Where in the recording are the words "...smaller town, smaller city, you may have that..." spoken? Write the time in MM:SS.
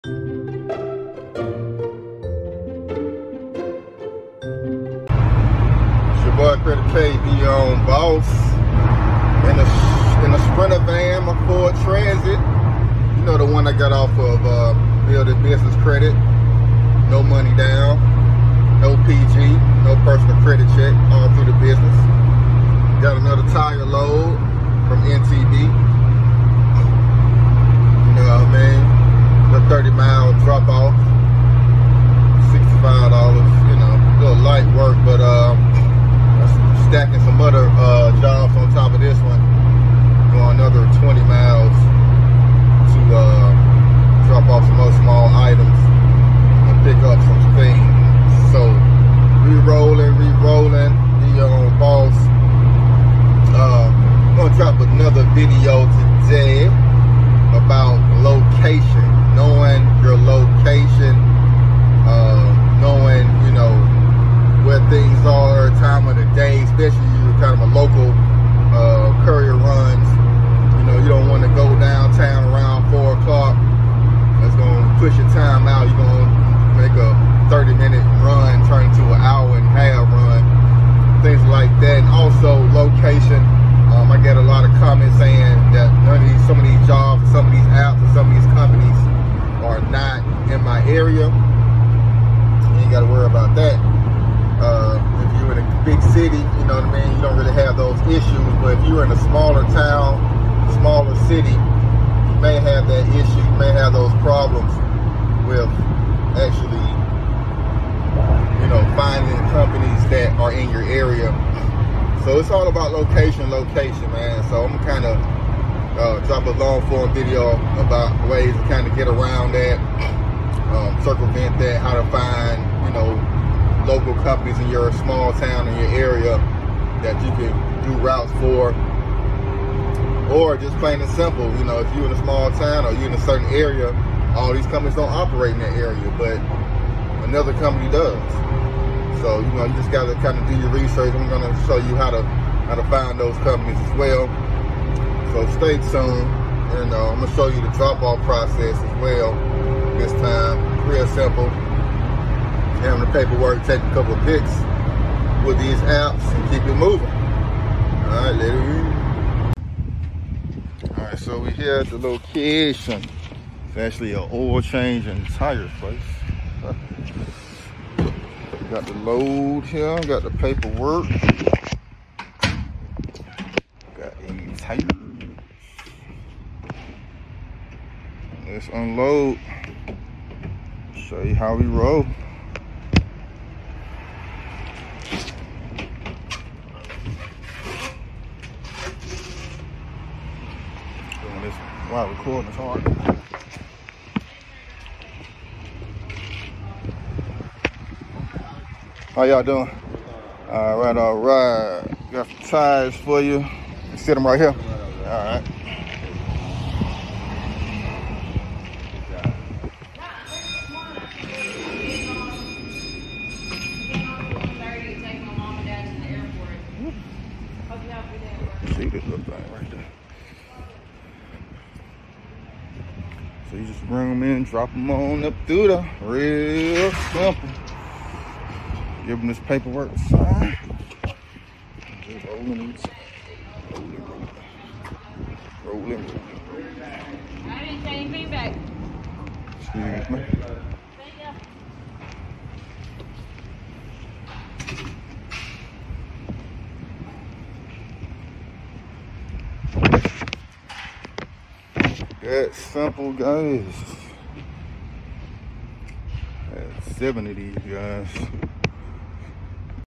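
01:39.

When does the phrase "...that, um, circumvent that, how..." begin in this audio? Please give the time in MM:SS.
01:59.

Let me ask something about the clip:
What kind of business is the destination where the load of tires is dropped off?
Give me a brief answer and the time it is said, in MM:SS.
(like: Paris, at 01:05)
Oil change and tire place, at 02:44.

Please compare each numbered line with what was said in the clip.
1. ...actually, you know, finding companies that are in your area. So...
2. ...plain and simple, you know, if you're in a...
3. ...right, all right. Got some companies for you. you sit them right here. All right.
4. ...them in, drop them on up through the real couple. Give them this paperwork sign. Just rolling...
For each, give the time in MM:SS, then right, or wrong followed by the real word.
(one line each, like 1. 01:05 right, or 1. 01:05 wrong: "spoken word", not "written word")
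1. 01:46 right
2. 02:10 right
3. 03:20 wrong: "tires", not "companies"
4. 03:44 wrong: "simple", not "couple".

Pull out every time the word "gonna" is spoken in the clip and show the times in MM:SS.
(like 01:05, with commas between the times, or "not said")
02:21, 02:27.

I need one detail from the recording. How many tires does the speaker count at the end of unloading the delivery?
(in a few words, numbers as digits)
7.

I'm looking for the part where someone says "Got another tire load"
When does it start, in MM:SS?
00:23.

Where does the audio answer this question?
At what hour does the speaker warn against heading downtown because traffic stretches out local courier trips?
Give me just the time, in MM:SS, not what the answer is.
01:12.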